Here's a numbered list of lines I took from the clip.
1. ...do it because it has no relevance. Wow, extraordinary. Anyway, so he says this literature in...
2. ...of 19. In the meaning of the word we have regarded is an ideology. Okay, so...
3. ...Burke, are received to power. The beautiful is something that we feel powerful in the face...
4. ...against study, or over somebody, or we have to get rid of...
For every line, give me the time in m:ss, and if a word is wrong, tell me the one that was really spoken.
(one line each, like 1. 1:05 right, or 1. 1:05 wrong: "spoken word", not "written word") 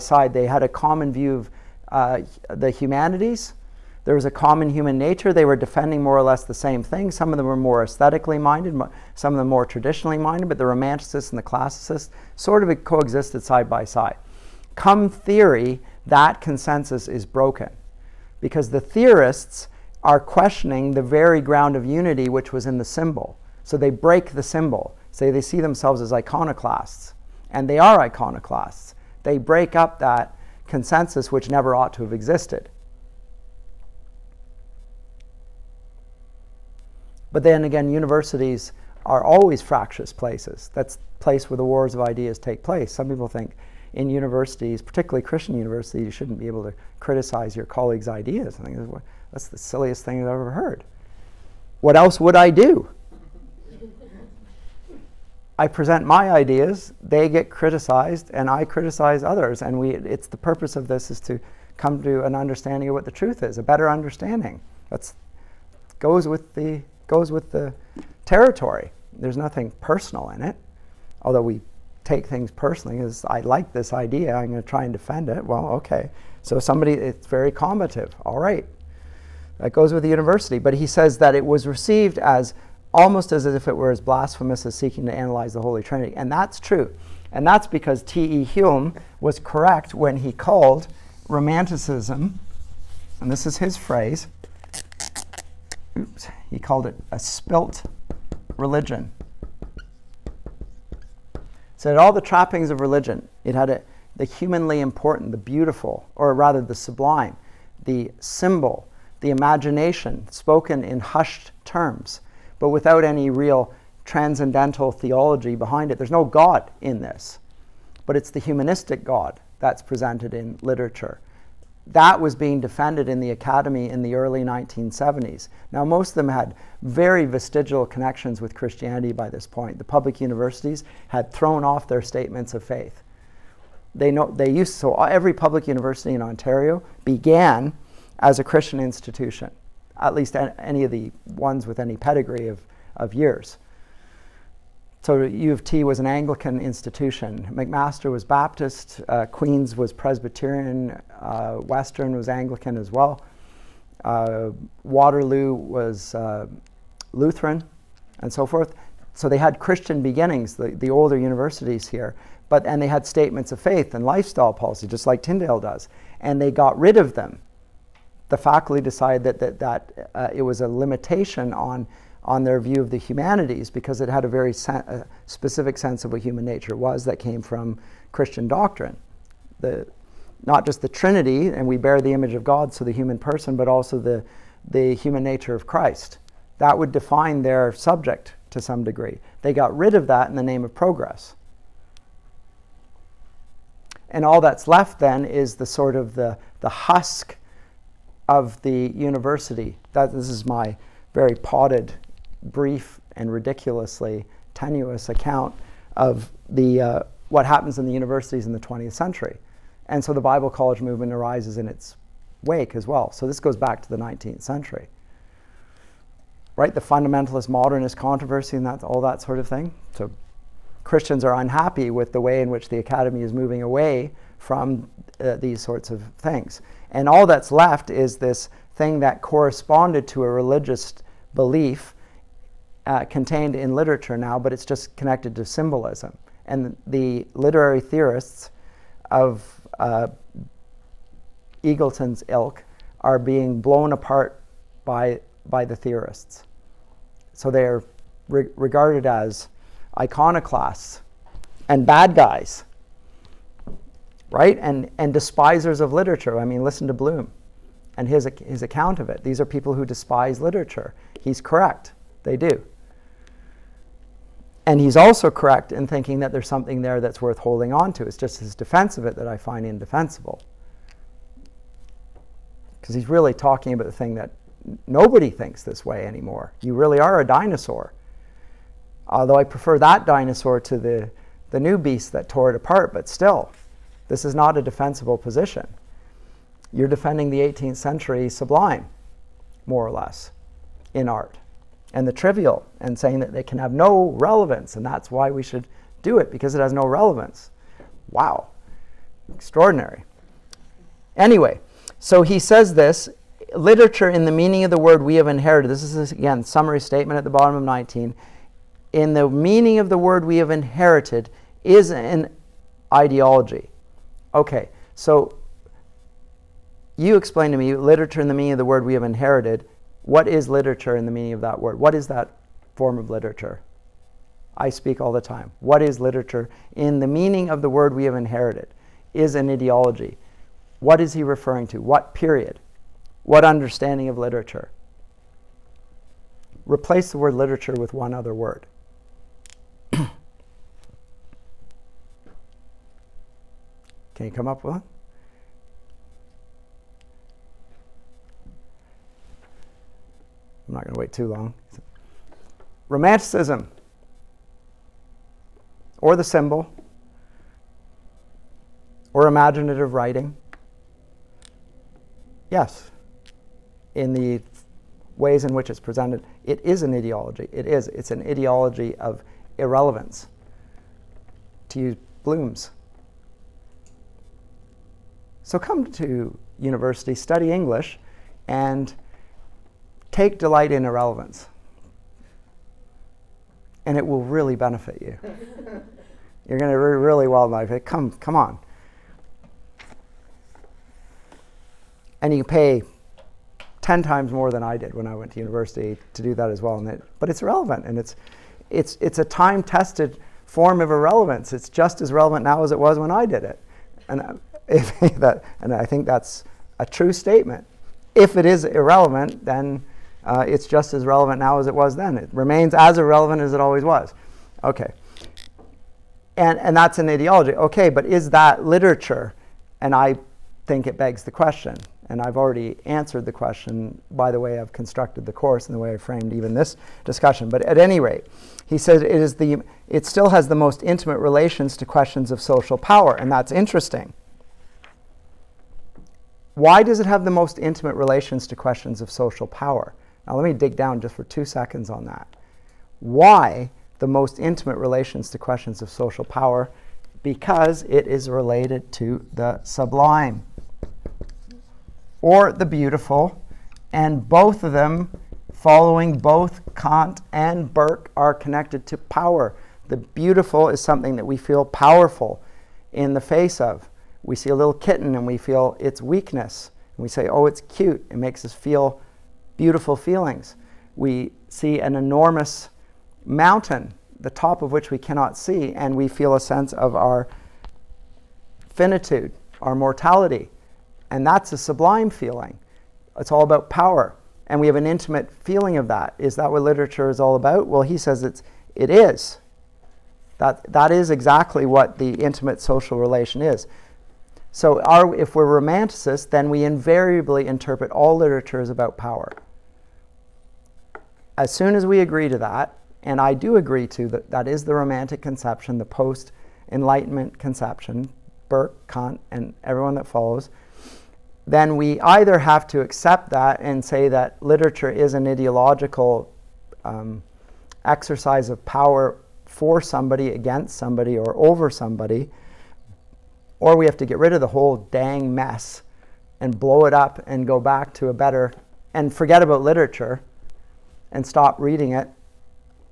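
1. 4:56 right
2. 5:07 wrong: "inherited", not "regarded"
3. 7:37 wrong: "connected", not "received"
4. 8:40 wrong: "somebody", not "study".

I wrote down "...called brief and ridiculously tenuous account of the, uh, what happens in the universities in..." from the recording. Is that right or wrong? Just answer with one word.
wrong.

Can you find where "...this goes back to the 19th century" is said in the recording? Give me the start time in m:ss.
3:33.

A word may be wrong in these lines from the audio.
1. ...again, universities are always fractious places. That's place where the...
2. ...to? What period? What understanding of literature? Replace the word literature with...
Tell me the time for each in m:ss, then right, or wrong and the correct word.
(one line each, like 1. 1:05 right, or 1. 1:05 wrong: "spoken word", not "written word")
1. 0:37 right
2. 5:31 right.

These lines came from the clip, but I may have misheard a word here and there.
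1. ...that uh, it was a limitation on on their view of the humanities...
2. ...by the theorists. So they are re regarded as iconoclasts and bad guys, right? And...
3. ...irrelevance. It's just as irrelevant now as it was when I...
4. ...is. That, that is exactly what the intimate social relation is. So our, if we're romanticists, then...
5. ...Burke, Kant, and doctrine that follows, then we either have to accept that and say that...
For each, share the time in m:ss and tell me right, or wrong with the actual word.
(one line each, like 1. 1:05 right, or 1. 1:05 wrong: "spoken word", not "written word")
1. 2:49 right
2. 4:05 right
3. 6:40 wrong: "relevant", not "irrelevant"
4. 8:08 right
5. 8:28 wrong: "everyone", not "doctrine".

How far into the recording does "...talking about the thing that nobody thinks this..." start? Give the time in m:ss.
4:33.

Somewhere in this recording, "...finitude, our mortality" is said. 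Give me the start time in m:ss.
7:58.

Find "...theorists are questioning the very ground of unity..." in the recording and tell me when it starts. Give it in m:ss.
0:18.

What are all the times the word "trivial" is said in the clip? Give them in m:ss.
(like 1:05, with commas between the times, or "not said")
4:52.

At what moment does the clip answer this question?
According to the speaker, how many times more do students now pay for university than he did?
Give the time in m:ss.
6:33.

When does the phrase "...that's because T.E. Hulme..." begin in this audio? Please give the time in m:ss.
1:27.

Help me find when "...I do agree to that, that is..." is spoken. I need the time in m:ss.
8:23.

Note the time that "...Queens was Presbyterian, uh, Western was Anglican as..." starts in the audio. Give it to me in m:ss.
2:29.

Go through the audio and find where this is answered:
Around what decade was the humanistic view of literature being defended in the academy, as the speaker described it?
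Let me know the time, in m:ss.
2:04.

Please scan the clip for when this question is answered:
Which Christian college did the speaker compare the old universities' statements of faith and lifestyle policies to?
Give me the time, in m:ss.
2:45.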